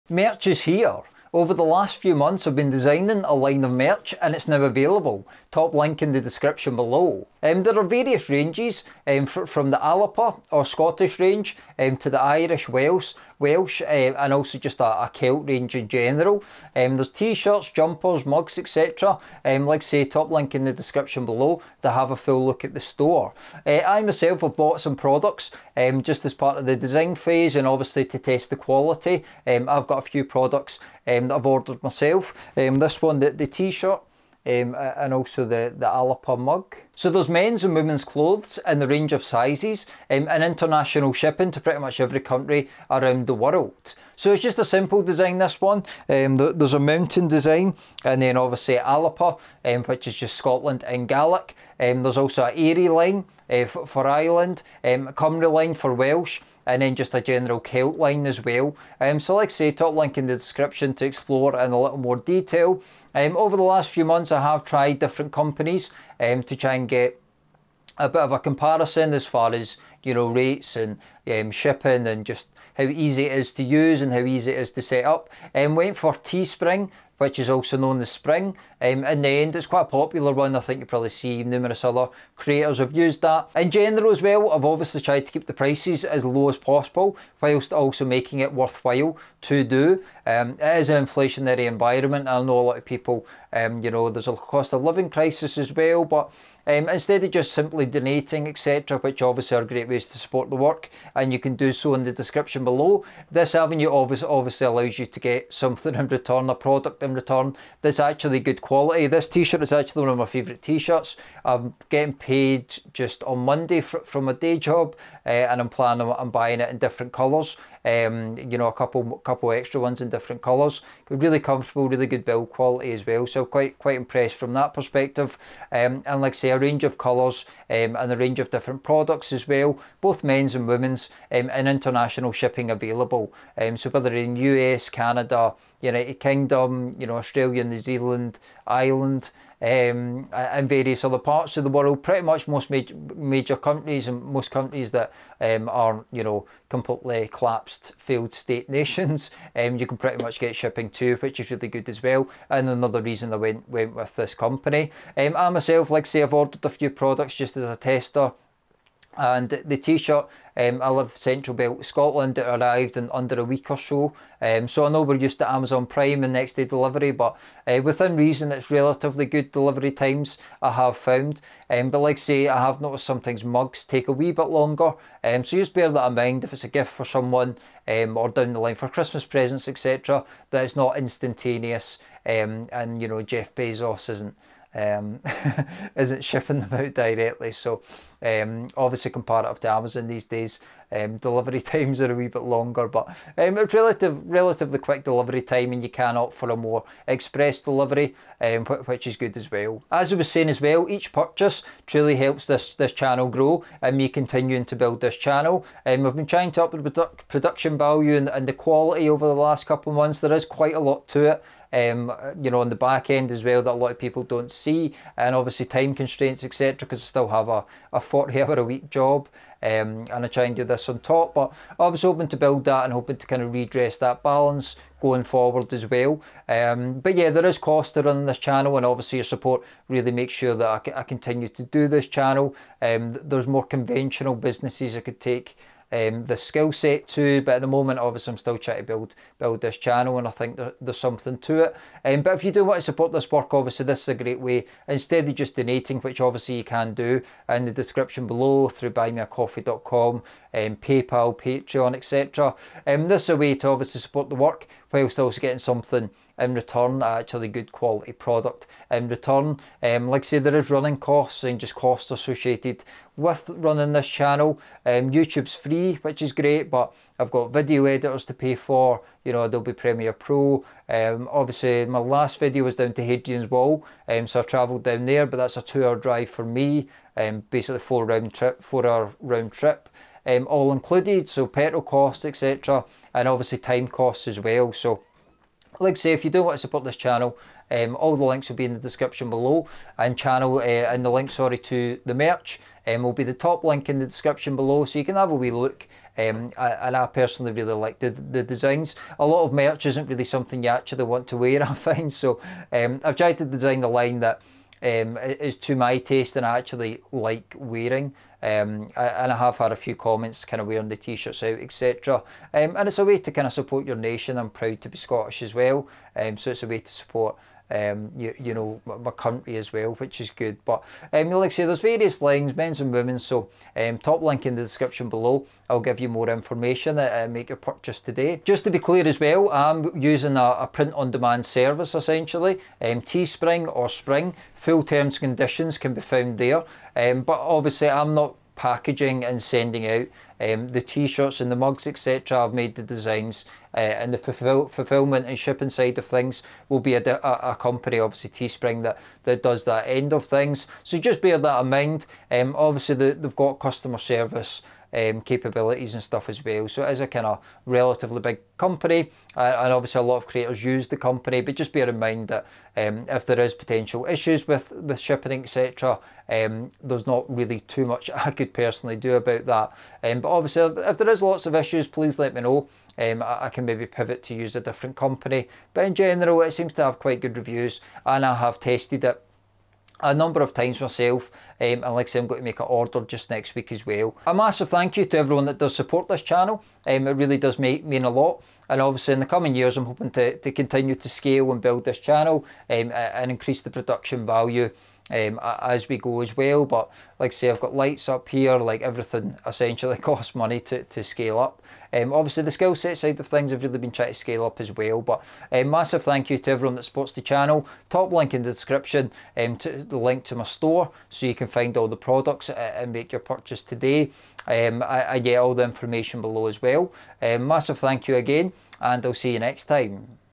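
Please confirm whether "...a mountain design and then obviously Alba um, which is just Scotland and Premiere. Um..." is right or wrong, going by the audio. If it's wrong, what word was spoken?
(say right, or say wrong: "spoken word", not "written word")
wrong: "Gaelic", not "Premiere".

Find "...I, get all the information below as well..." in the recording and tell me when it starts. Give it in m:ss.
6:55.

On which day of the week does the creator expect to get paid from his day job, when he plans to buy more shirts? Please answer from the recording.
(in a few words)
Monday.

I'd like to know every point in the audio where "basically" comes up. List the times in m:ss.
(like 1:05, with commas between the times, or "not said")
4:37.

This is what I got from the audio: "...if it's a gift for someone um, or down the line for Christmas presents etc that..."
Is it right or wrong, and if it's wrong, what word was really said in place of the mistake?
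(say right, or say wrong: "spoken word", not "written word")
right.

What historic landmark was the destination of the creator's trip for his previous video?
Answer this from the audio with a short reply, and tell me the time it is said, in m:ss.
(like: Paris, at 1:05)
Hadrian's Wall, at 4:33.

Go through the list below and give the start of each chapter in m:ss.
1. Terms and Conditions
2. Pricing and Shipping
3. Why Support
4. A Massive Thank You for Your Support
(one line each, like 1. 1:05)
1. 5:28
2. 1:23
3. 3:19
4. 6:23.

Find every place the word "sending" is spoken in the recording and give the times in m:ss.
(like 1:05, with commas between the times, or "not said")
5:39.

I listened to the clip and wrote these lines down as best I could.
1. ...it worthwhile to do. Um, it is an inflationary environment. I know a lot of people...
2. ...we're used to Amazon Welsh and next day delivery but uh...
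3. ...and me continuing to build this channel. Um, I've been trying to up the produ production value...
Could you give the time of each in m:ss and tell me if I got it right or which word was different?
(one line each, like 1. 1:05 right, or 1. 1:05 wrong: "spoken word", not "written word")
1. 1:28 right
2. 2:45 wrong: "Prime", not "Welsh"
3. 3:23 right.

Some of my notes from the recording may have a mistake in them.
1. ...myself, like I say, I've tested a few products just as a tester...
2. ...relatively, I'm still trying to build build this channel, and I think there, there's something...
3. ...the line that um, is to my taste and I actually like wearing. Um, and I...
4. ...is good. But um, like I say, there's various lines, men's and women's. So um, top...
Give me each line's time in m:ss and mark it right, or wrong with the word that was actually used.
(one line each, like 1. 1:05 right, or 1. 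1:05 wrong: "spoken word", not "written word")
1. 2:35 wrong: "ordered", not "tested"
2. 3:57 wrong: "obviously", not "relatively"
3. 5:03 right
4. 5:20 right.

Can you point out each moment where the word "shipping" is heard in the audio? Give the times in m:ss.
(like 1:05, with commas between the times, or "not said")
0:41, 1:11, 2:12, 2:30, 3:06, 5:45, 6:04.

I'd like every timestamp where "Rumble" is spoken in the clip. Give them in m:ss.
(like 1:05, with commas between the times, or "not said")
not said.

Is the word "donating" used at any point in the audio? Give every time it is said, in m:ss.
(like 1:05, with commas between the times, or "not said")
1:37, 4:05.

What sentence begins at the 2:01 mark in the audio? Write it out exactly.
Really comfortable, really good build quality as well.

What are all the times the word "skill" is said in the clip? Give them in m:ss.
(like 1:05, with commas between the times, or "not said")
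3:56, 6:42.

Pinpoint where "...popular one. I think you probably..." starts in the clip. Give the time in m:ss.
1:19.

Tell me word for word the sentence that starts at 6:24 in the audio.
A massive thank you to everyone that does support this channel.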